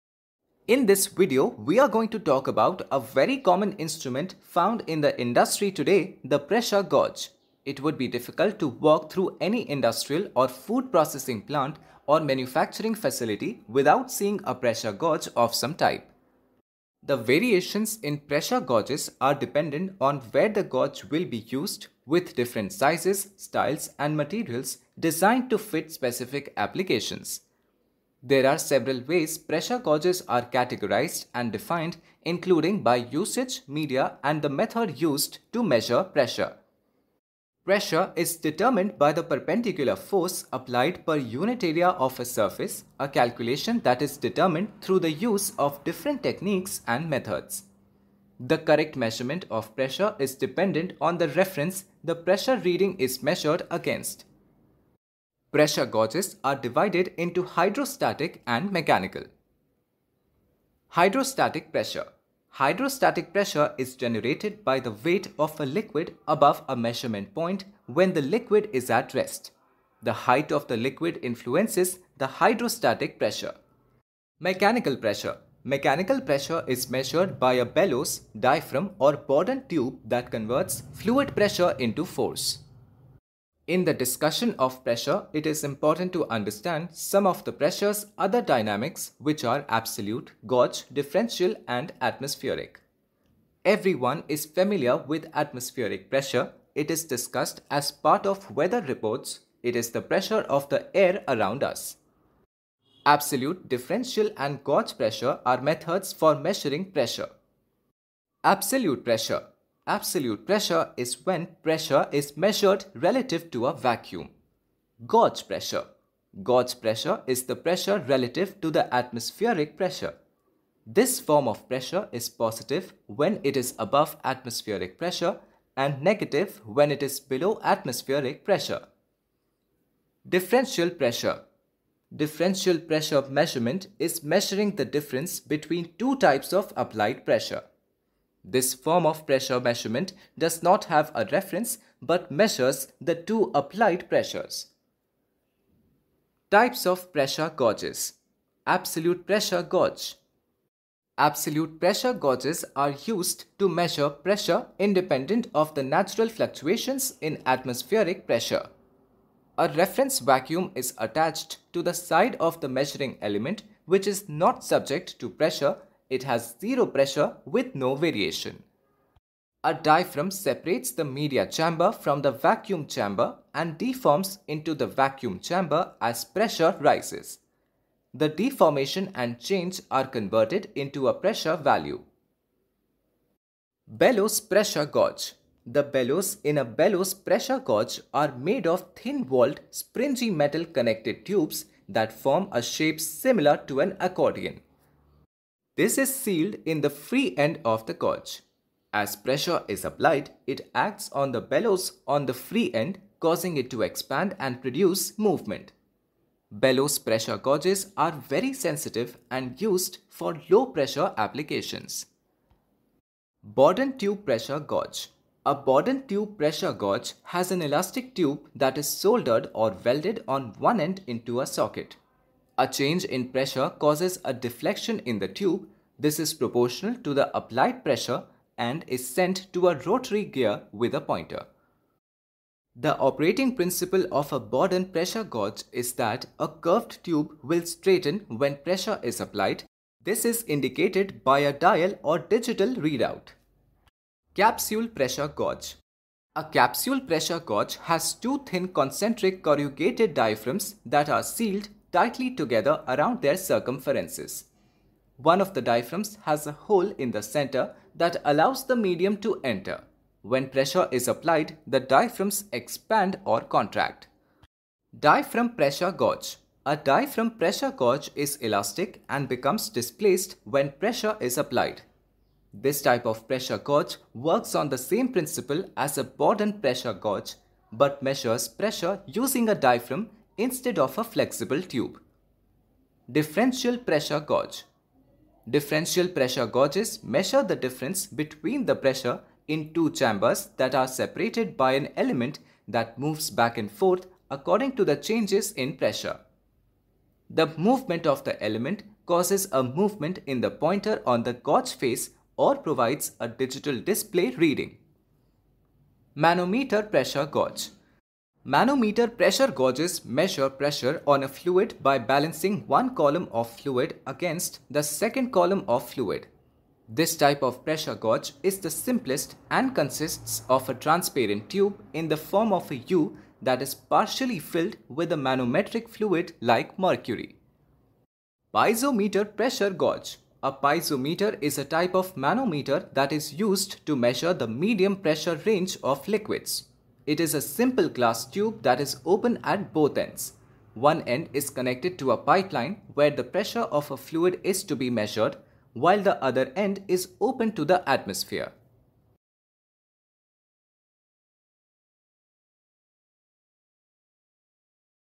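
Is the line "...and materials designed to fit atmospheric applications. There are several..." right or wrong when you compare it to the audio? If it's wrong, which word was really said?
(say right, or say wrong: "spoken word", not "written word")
wrong: "specific", not "atmospheric".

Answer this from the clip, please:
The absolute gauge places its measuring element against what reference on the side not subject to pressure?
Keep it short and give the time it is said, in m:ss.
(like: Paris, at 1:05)
A reference vacuum, at 2:39.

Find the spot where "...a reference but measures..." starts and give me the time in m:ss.
2:21.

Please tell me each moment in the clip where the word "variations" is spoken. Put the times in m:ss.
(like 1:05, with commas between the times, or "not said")
0:17, 2:47.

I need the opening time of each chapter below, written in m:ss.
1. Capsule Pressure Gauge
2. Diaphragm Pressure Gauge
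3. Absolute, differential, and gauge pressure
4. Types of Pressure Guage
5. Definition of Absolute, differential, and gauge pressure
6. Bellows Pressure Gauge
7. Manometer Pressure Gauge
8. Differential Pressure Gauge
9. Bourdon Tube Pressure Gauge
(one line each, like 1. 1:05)
1. 4:05
2. 4:25
3. 1:23
4. 2:26
5. 1:49
6. 3:04
7. 5:05
8. 4:43
9. 3:33.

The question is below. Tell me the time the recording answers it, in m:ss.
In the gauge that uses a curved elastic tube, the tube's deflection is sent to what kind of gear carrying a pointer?
3:49.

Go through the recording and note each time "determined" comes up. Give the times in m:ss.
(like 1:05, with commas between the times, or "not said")
0:38, 0:44.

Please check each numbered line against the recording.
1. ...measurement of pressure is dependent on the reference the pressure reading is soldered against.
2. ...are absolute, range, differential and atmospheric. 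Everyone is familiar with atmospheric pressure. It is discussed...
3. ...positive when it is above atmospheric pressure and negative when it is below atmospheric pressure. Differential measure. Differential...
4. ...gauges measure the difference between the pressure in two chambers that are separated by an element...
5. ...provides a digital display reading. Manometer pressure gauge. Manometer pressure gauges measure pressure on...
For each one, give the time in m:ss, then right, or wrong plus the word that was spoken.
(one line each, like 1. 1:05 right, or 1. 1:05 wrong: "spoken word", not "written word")
1. 0:48 wrong: "measured", not "soldered"
2. 1:29 wrong: "gauge", not "range"
3. 2:02 wrong: "pressure", not "measure"
4. 4:46 right
5. 5:02 right.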